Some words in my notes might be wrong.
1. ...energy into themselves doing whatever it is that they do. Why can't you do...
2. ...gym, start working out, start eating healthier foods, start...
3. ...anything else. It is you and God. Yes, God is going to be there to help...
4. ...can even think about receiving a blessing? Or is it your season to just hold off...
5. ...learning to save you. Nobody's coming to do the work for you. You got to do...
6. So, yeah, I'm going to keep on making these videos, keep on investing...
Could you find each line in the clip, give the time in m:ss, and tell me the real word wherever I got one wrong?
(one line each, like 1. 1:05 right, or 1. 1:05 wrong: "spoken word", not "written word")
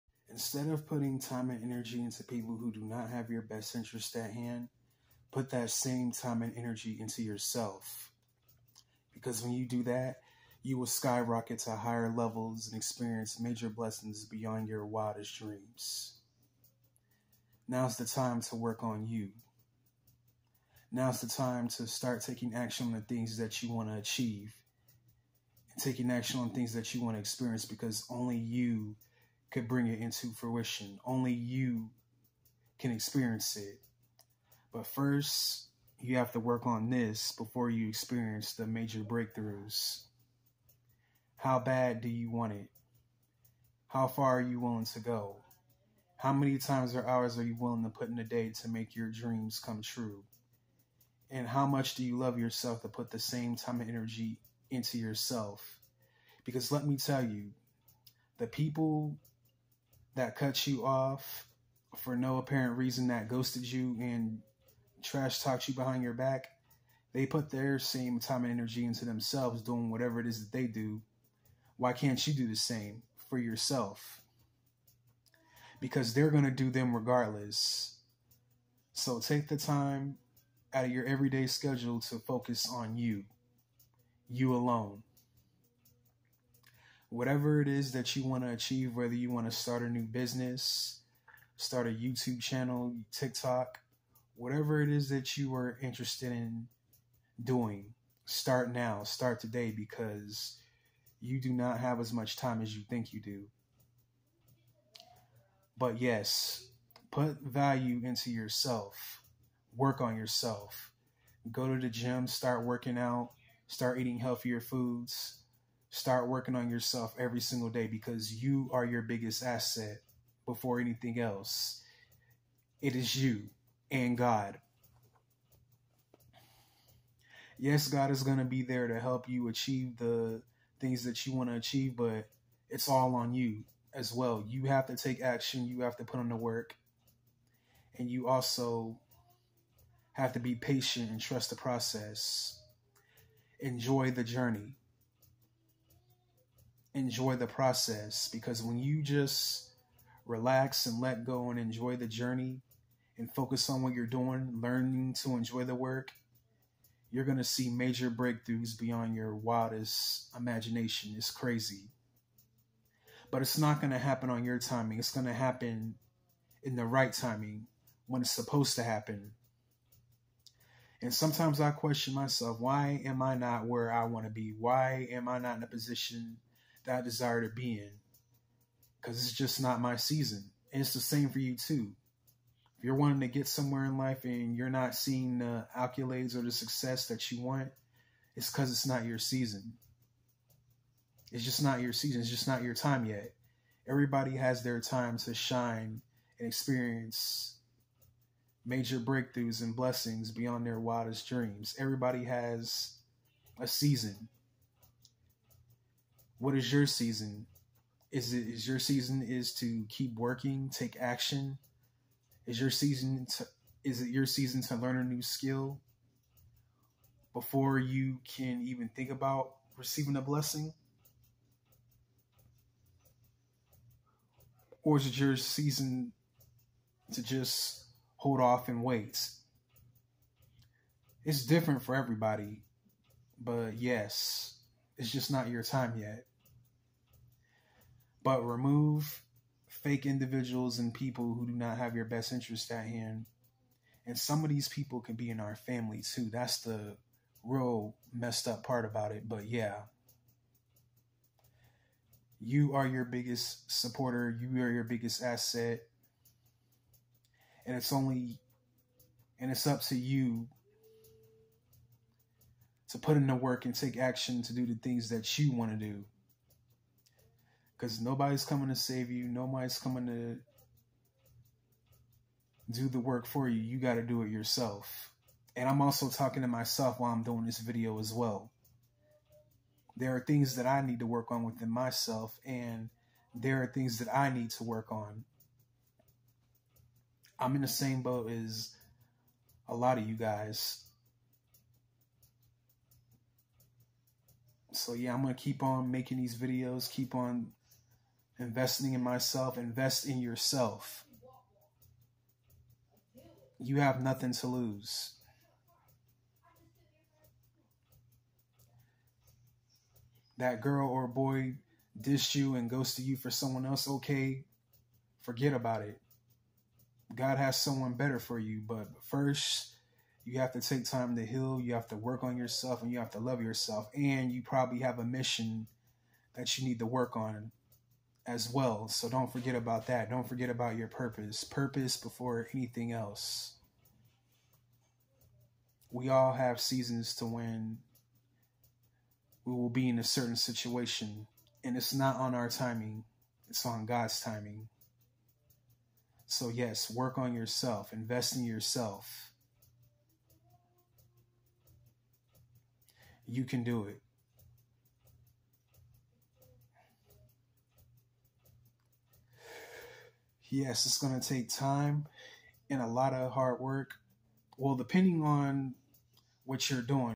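1. 1:08 right
2. 1:51 right
3. 2:00 right
4. 3:38 right
5. 4:28 wrong: "coming", not "learning"
6. 4:54 right.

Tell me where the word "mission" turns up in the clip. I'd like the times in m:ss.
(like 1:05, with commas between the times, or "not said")
5:25.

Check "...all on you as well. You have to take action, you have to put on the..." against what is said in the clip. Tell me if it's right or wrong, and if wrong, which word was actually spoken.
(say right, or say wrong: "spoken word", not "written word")
right.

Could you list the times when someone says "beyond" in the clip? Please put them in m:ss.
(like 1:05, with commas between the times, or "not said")
0:14, 2:38, 3:20.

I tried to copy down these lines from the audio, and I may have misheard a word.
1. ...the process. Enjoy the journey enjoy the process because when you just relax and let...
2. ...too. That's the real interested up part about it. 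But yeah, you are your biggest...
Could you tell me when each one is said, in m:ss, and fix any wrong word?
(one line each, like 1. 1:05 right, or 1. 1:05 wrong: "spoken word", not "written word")
1. 2:21 right
2. 4:06 wrong: "messed", not "interested".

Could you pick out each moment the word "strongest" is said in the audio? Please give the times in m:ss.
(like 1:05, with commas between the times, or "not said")
not said.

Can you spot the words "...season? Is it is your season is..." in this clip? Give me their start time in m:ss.
3:26.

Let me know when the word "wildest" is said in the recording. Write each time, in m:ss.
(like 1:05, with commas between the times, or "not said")
0:14, 2:39, 3:20.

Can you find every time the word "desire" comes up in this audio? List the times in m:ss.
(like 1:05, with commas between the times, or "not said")
2:57.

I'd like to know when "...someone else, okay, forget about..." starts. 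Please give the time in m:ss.
5:13.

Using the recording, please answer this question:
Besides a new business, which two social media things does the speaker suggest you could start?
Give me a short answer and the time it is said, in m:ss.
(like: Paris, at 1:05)
YouTube channel, TikTok, at 1:31.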